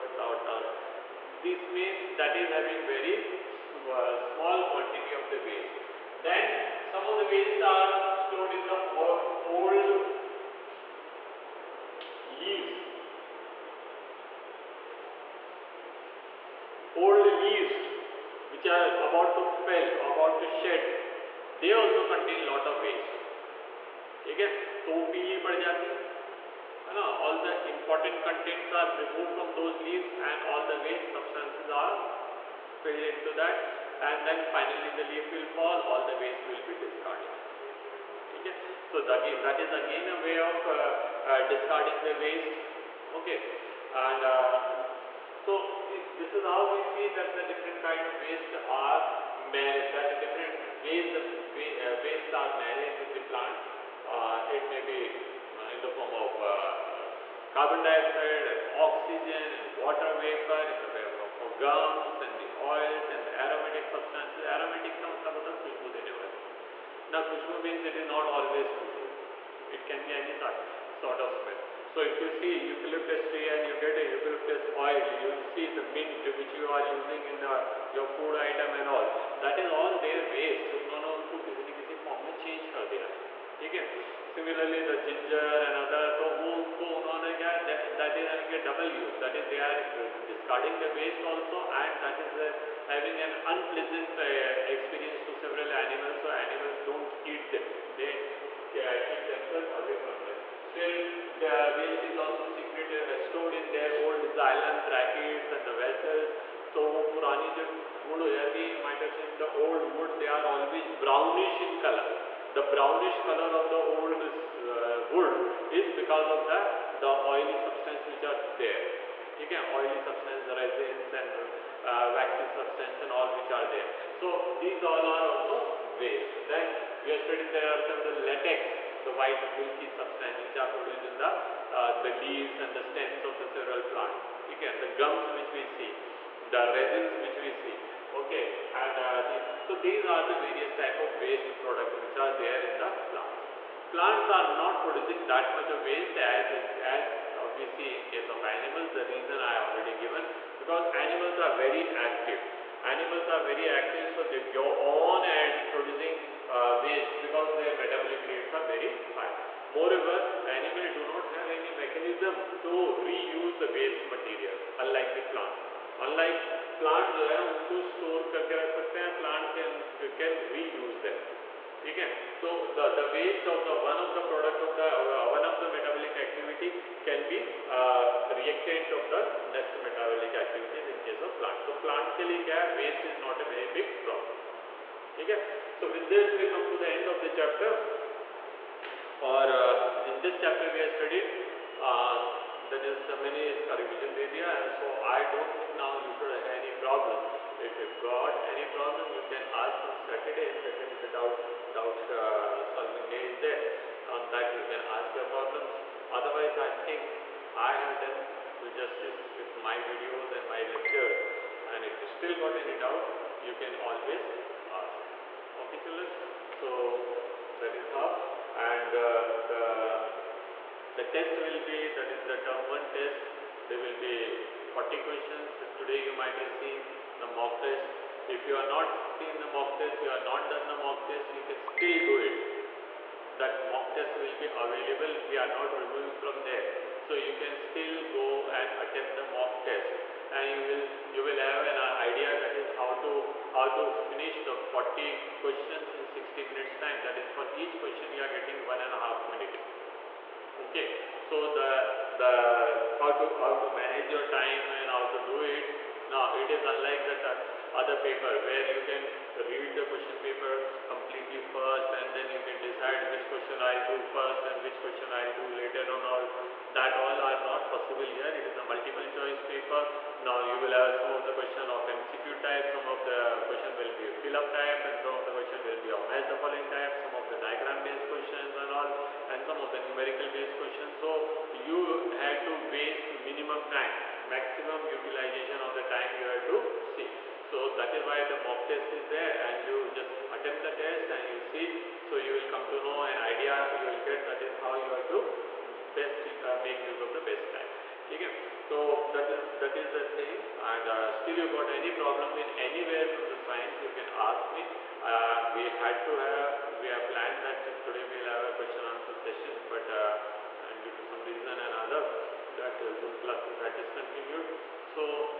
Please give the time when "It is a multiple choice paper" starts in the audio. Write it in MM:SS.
04:28.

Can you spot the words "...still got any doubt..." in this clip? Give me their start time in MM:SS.
03:32.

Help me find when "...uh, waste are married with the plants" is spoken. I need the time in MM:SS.
00:51.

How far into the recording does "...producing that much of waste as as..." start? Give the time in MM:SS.
02:24.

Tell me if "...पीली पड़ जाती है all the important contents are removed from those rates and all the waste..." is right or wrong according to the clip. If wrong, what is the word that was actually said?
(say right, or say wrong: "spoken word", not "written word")
wrong: "leaves", not "rates".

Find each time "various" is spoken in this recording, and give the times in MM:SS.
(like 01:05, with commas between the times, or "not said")
02:20.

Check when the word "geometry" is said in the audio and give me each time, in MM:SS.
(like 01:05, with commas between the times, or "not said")
not said.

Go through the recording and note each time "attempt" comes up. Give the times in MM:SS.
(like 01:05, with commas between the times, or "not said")
03:58, 04:50.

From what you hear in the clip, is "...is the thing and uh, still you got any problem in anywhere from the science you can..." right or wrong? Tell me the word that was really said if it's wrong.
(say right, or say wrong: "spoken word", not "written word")
right.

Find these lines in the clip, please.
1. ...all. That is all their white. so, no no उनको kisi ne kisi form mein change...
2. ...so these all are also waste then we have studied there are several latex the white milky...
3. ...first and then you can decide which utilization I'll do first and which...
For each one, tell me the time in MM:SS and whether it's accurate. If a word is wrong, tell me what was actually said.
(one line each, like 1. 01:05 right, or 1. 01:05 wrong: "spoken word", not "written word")
1. 01:18 wrong: "waste", not "white"
2. 02:04 right
3. 04:21 wrong: "question", not "utilization".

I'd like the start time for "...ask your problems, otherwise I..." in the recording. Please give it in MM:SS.
03:24.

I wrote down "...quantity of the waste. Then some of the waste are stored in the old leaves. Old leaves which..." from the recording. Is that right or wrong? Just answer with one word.
right.